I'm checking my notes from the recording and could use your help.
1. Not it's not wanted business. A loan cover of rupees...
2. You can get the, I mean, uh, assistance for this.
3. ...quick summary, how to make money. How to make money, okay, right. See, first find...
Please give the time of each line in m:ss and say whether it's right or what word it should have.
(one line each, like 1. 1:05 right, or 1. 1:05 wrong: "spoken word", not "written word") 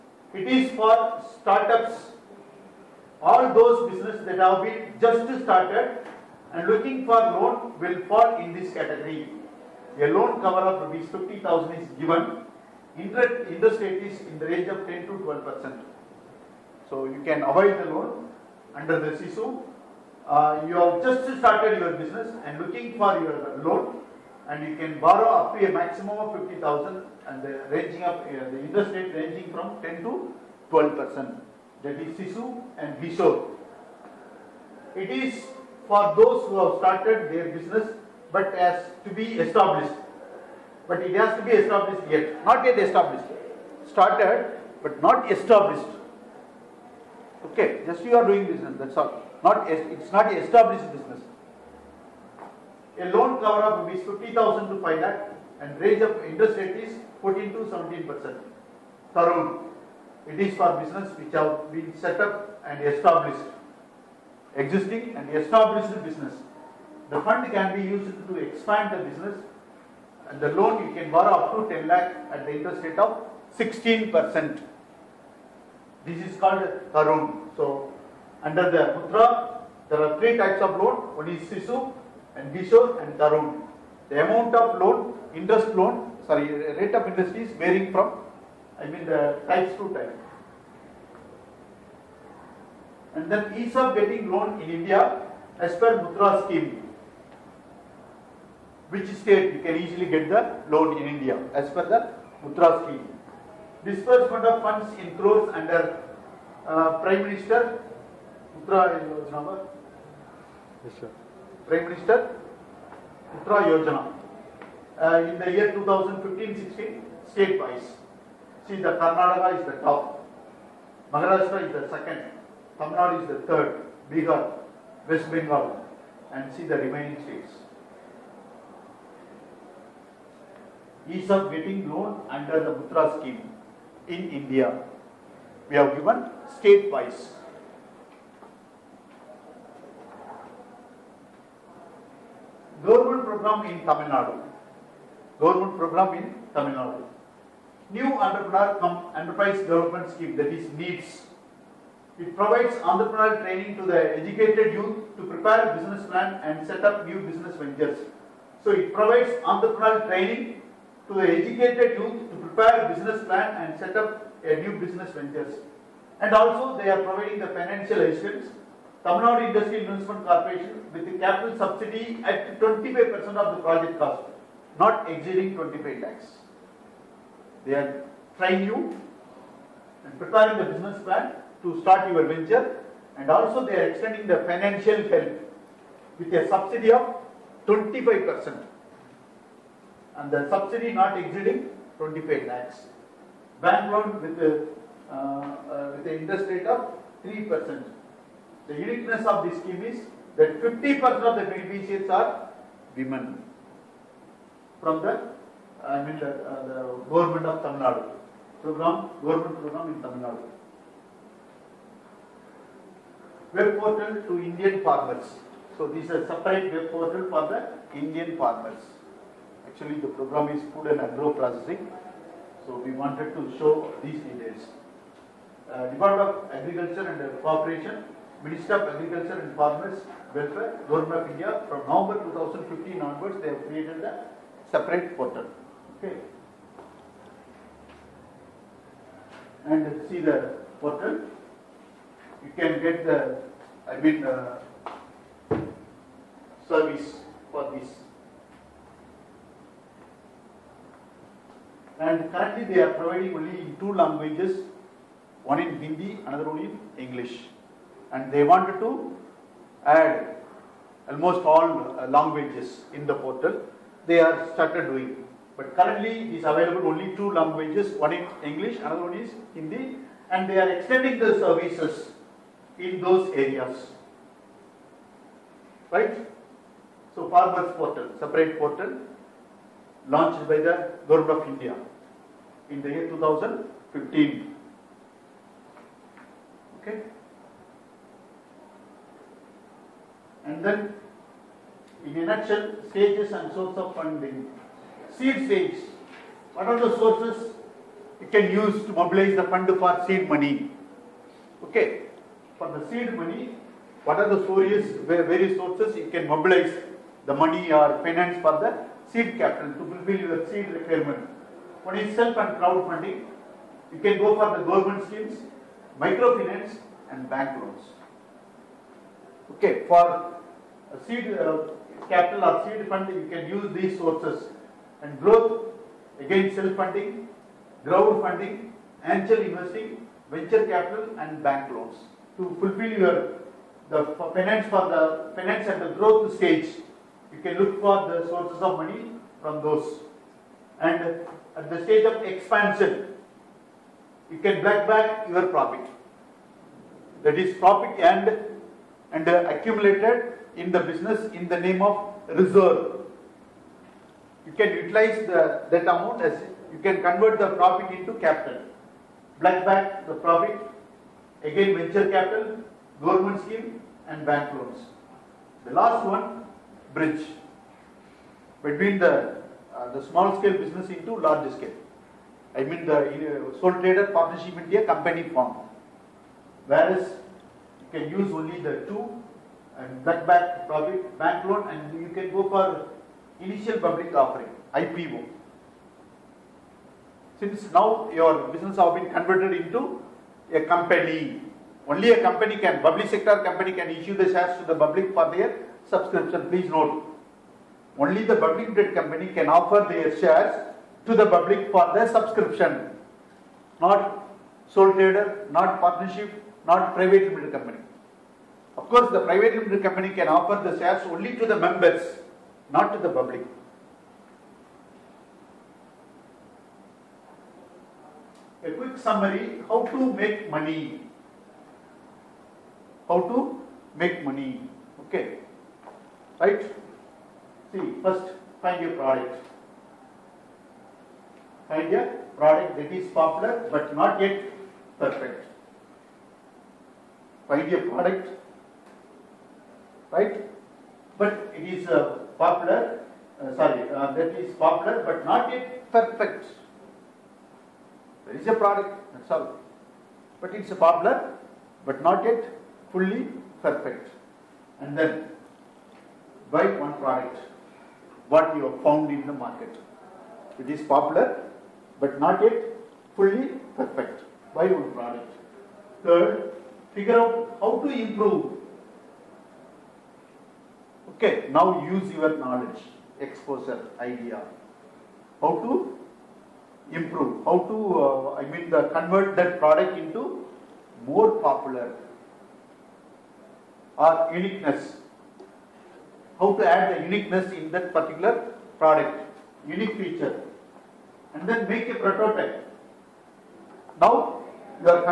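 1. 0:49 wrong: "established", not "wanted"
2. 4:02 wrong: "service", not "assistance"
3. 6:58 right.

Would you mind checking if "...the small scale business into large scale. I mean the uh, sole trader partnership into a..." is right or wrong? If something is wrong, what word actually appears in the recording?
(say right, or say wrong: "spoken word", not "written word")
right.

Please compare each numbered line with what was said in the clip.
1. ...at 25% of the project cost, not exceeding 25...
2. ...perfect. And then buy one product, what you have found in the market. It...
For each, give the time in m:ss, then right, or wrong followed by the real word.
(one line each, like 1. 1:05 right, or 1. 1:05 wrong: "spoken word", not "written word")
1. 2:52 right
2. 7:33 right.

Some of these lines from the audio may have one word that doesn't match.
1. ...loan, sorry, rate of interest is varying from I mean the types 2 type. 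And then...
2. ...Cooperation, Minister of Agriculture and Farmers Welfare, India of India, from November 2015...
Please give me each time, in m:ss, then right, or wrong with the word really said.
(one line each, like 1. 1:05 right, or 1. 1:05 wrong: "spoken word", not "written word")
1. 1:25 right
2. 3:47 wrong: "Government", not "India".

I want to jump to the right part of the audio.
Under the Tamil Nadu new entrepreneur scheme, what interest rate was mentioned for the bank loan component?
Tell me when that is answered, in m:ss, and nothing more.
3:17.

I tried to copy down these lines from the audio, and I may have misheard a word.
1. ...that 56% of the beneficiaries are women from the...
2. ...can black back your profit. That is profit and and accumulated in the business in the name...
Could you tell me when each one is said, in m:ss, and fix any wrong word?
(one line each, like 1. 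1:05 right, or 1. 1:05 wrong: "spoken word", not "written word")
1. 3:20 wrong: "50", not "56"
2. 5:44 right.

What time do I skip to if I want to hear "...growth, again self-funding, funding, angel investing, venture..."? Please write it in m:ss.
5:25.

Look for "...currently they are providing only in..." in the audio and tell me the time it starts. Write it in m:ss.
4:12.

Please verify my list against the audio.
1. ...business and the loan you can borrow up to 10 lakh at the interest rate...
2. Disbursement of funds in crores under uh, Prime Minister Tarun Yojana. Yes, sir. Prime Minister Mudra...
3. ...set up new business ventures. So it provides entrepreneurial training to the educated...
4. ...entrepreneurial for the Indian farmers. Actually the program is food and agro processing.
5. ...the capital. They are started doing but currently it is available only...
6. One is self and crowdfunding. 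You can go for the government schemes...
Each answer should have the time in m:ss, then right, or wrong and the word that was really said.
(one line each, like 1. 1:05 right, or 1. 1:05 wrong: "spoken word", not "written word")
1. 1:09 right
2. 1:43 wrong: "Mudra", not "Tarun"
3. 2:36 right
4. 3:36 wrong: "portal", not "entrepreneurial"
5. 4:23 wrong: "portal", not "capital"
6. 5:11 right.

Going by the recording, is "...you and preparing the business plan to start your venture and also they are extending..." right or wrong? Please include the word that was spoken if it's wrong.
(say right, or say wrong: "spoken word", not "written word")
right.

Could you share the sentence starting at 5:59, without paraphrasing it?
Black back the profit, again venture capital, government scheme and bank loans.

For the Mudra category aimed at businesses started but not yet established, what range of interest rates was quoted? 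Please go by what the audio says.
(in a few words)
14 to 17 percent.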